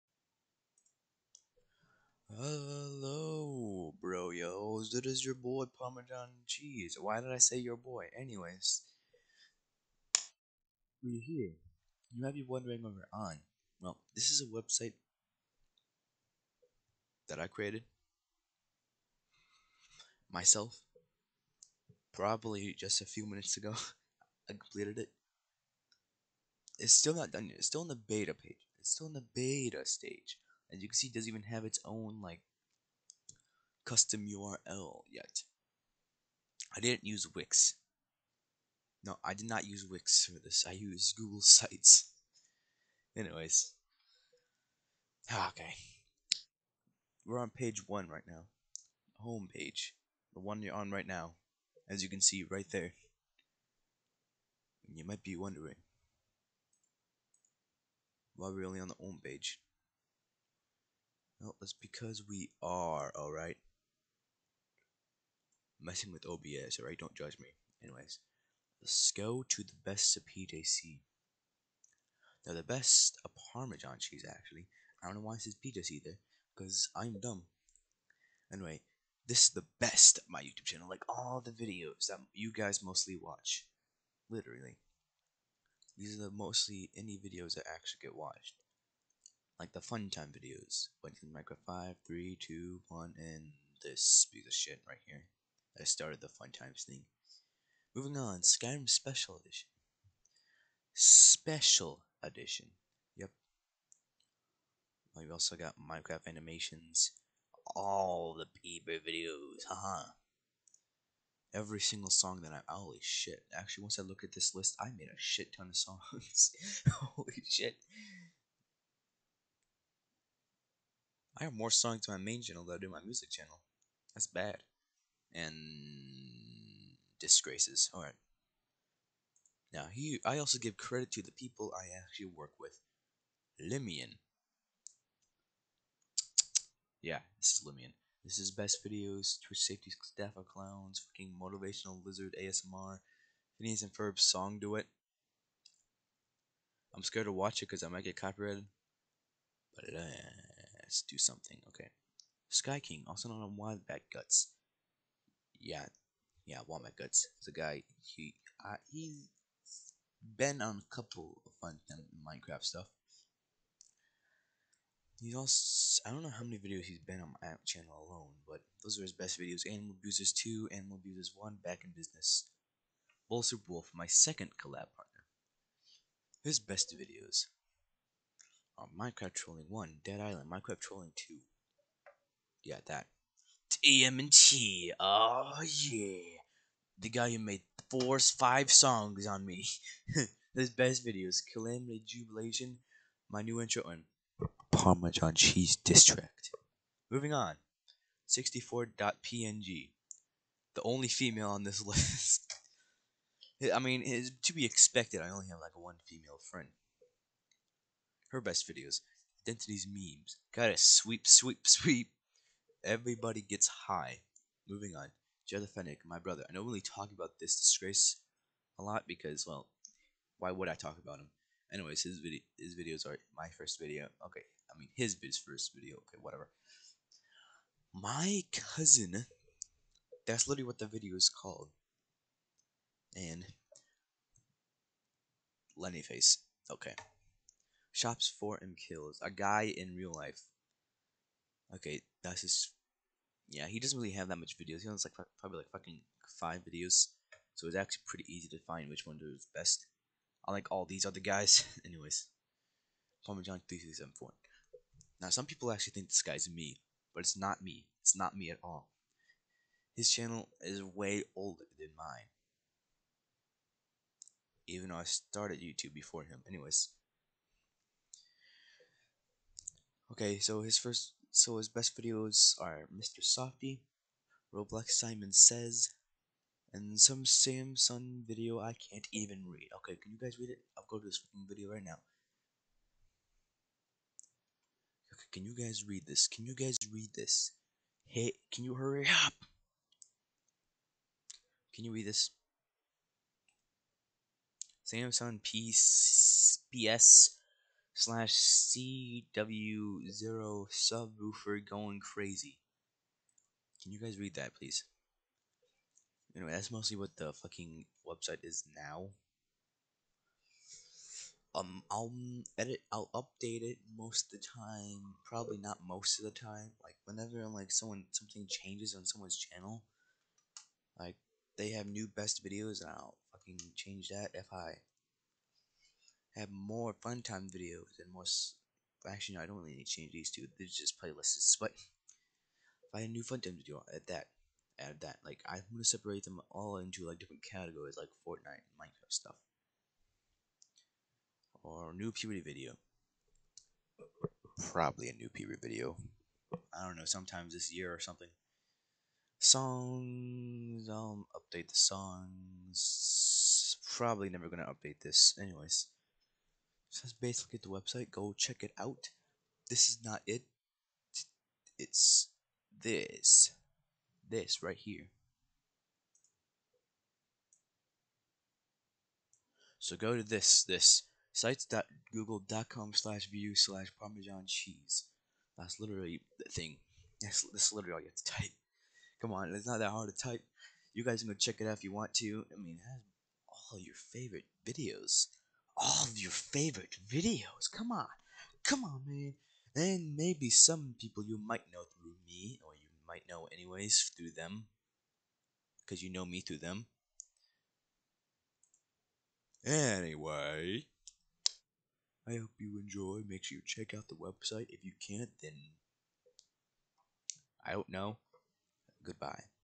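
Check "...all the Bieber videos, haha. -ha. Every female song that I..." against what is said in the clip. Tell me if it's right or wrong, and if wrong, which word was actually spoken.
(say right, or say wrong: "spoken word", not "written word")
wrong: "single", not "female".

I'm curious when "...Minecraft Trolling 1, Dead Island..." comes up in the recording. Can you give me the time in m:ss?
2:58.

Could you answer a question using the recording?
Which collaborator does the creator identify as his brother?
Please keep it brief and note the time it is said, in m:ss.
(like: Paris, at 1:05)
Jetta Fennec, at 3:35.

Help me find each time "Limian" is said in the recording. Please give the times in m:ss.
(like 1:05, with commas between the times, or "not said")
2:13, 2:17.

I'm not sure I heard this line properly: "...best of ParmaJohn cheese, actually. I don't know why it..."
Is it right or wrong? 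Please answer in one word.
right.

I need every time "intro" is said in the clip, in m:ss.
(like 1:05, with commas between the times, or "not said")
3:13.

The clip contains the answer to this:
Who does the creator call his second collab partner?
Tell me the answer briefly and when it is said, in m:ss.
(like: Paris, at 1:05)
Bull Super Wolf, at 2:53.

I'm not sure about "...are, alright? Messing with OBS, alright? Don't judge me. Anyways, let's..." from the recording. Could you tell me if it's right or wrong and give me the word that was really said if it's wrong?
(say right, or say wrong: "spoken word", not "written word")
right.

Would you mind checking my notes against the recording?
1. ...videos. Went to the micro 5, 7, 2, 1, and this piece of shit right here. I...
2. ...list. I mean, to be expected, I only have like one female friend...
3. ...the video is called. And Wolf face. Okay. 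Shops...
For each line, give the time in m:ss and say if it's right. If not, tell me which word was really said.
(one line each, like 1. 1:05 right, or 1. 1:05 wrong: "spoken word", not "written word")
1. 1:30 wrong: "3", not "7"
2. 3:21 right
3. 3:50 wrong: "Lenny", not "Wolf".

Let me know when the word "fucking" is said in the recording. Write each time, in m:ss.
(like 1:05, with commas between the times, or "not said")
2:20, 4:05, 5:07, 5:23.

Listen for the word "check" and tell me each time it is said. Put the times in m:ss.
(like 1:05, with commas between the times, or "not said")
5:58, 6:21, 6:43.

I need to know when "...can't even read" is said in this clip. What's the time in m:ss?
4:38.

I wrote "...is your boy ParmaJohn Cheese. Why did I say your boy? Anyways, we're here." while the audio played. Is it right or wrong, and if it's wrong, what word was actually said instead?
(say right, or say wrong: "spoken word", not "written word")
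right.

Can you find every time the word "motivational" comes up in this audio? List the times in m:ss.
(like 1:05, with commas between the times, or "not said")
2:21.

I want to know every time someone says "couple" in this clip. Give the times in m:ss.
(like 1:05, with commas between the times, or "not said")
2:40.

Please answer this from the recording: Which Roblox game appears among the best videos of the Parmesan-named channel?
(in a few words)
Simon Says.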